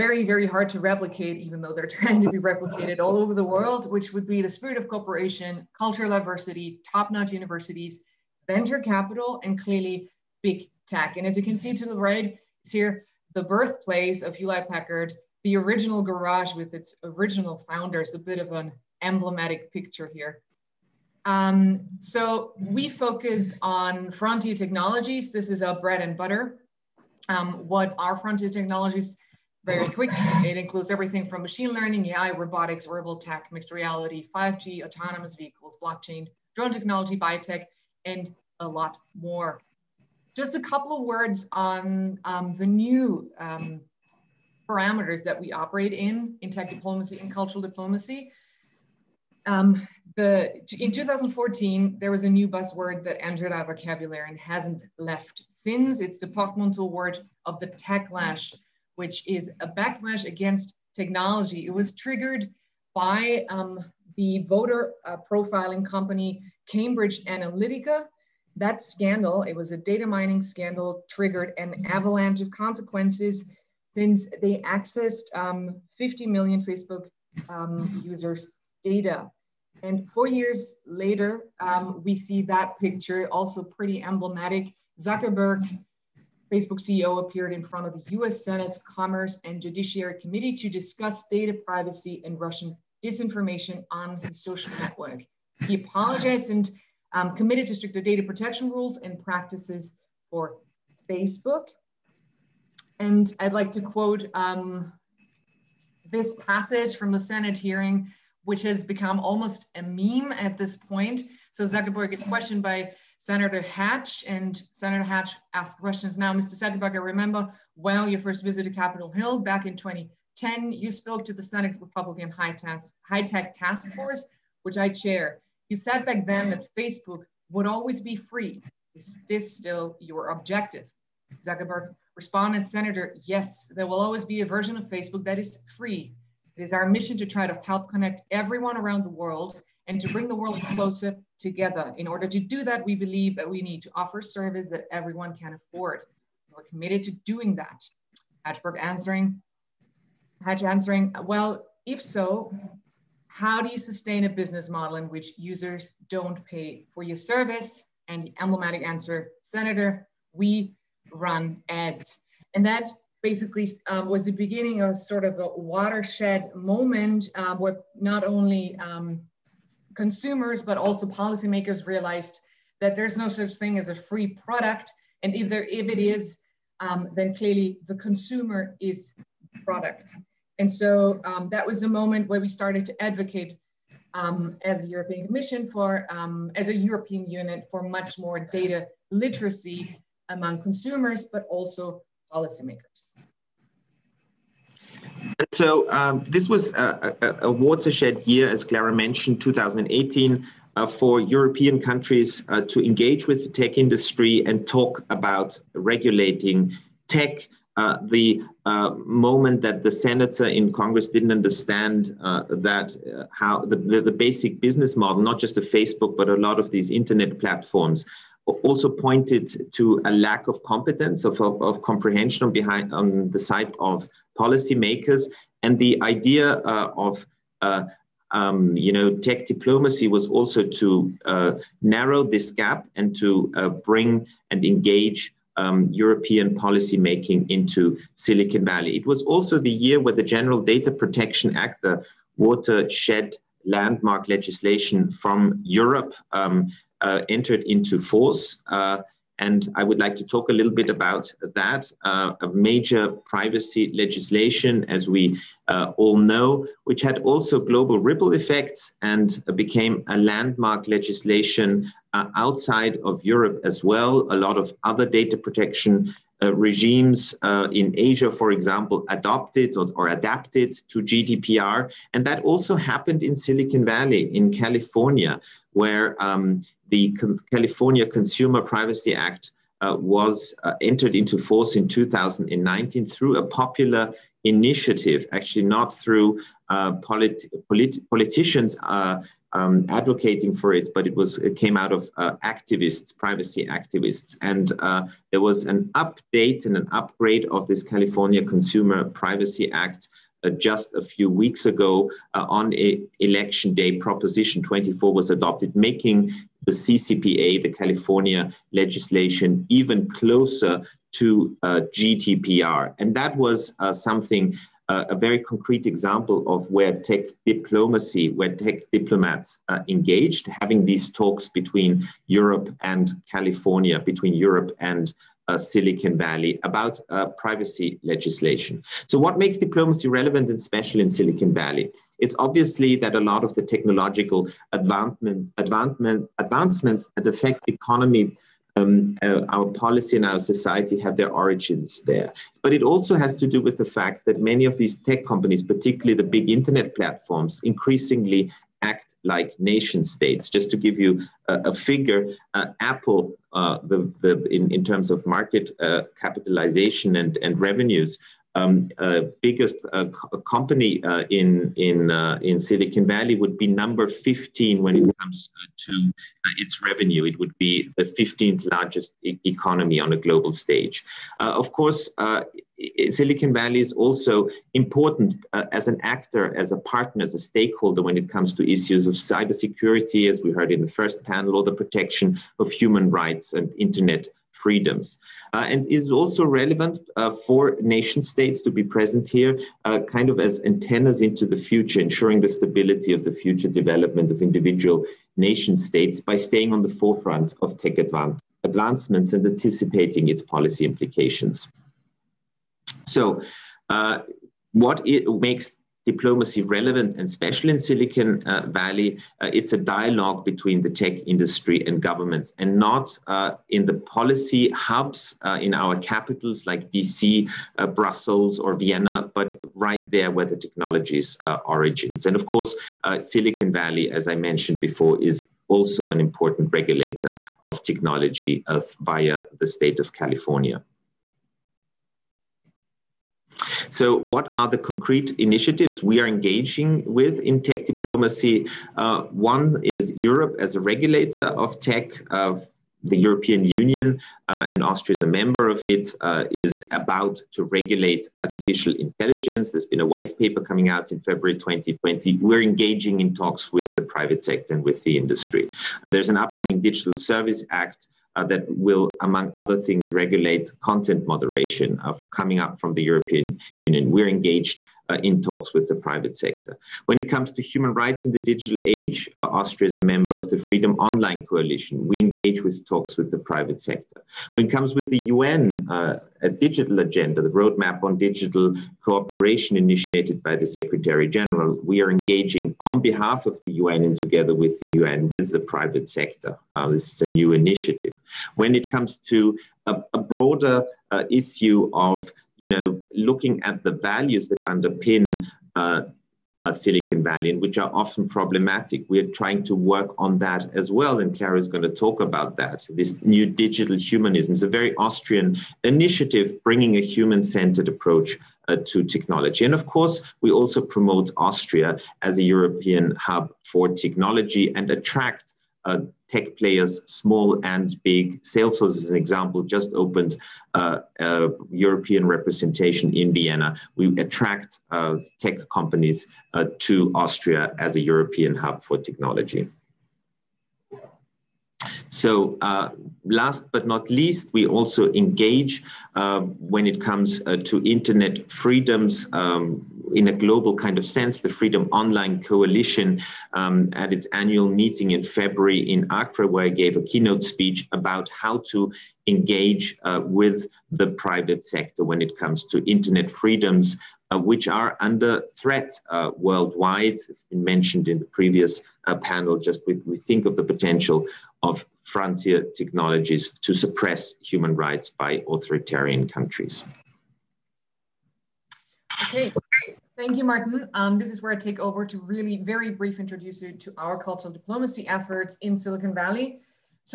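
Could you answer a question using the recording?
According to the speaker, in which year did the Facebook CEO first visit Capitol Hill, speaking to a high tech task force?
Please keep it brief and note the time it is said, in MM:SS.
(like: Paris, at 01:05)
2010, at 01:59.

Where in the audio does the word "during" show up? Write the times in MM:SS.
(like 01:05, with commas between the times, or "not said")
not said.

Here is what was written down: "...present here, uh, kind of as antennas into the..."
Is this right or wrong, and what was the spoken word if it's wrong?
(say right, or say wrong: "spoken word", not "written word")
right.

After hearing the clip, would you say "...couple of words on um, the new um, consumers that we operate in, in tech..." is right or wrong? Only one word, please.
wrong.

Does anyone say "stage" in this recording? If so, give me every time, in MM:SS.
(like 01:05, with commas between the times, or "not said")
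06:10.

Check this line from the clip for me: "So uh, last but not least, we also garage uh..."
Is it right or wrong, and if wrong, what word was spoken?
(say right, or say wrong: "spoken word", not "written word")
wrong: "engage", not "garage".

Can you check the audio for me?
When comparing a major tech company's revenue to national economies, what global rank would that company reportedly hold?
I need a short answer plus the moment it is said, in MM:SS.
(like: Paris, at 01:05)
15th, at 06:08.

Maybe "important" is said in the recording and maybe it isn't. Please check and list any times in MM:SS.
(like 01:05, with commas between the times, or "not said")
06:14, 07:06.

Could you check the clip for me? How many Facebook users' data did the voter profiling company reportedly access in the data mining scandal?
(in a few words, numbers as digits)
50 million.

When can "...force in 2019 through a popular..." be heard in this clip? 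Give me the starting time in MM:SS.
04:41.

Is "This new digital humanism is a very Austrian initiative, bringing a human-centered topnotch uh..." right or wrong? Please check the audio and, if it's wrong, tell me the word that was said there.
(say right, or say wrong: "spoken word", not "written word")
wrong: "approach", not "topnotch".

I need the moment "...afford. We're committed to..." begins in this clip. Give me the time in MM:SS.
02:25.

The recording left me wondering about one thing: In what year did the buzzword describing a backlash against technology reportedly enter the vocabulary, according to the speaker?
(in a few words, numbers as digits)
2014.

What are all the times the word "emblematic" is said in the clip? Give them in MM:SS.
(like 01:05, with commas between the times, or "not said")
00:19, 01:24, 02:38.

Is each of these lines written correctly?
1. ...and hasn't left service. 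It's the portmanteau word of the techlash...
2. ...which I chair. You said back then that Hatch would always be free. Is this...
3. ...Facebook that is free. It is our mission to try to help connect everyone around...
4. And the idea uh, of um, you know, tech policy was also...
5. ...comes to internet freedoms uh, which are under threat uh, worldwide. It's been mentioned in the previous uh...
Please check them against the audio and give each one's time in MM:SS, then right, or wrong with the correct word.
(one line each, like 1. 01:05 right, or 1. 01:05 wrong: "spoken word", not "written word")
1. 00:54 wrong: "since", not "service"
2. 02:04 wrong: "Facebook", not "Hatch"
3. 02:14 right
4. 03:45 wrong: "diplomacy", not "policy"
5. 09:12 right.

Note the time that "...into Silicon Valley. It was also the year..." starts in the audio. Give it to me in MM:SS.
03:57.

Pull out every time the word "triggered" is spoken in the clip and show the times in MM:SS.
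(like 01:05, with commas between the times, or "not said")
01:01, 01:11.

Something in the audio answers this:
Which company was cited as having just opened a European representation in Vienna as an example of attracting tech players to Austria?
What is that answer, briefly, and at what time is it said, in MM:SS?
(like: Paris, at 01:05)
Salesforce, at 08:38.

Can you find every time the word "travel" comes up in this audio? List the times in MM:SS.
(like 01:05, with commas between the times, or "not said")
not said.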